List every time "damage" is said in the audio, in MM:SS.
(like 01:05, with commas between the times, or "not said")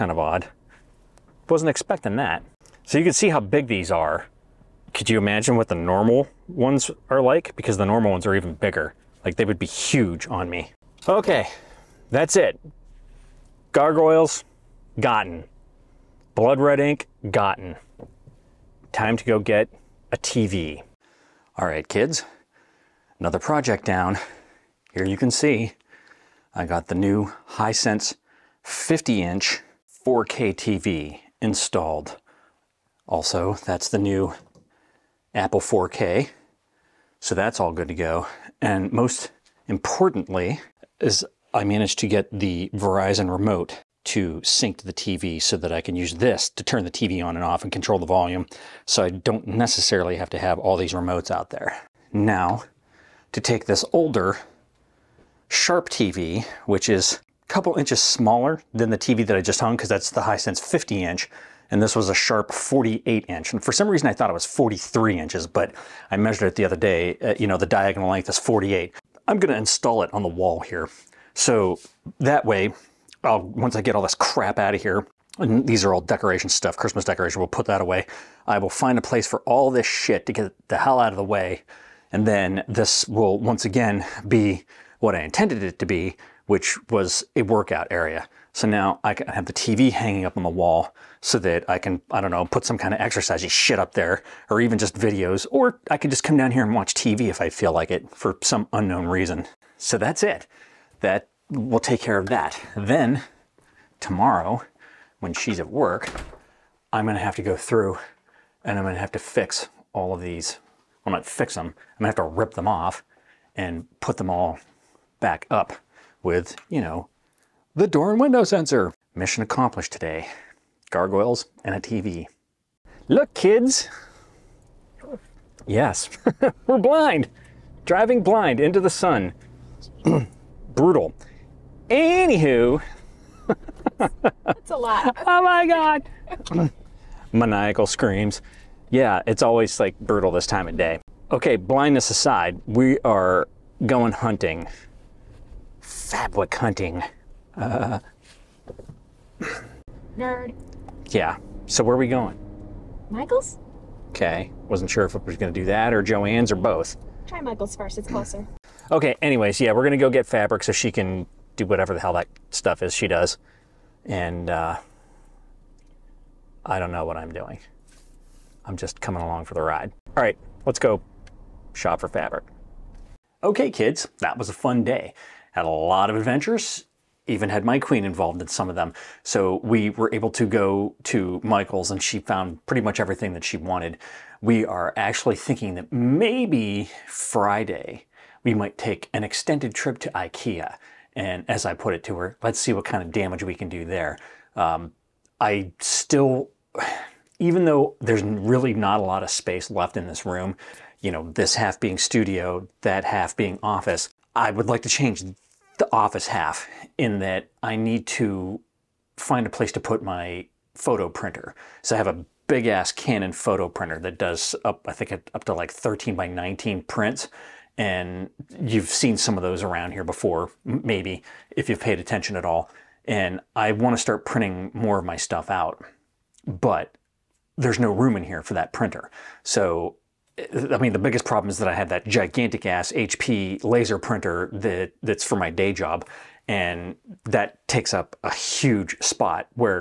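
03:13.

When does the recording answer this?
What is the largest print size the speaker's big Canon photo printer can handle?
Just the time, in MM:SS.
03:35.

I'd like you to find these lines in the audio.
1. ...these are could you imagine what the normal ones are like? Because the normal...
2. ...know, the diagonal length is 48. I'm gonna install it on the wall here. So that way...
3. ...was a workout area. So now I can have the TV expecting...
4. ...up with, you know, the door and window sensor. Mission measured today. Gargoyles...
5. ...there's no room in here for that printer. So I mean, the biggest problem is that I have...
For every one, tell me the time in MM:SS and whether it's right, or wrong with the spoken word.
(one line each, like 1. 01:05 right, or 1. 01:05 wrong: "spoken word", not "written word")
1. 00:03 right
2. 01:07 right
3. 01:26 wrong: "hanging", not "expecting"
4. 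01:55 wrong: "accomplished", not "measured"
5. 03:47 right.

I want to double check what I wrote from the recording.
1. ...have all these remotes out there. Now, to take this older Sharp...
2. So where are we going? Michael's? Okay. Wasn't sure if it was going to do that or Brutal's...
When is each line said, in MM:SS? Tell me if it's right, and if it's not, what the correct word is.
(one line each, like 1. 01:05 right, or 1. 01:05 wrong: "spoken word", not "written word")
1. 00:50 right
2. 02:31 wrong: "Joann", not "Brutal".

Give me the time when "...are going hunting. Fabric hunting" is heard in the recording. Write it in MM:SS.
02:23.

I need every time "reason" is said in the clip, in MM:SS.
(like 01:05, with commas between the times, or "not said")
01:03, 01:39.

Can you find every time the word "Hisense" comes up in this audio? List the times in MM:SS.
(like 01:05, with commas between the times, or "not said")
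00:27, 01:00.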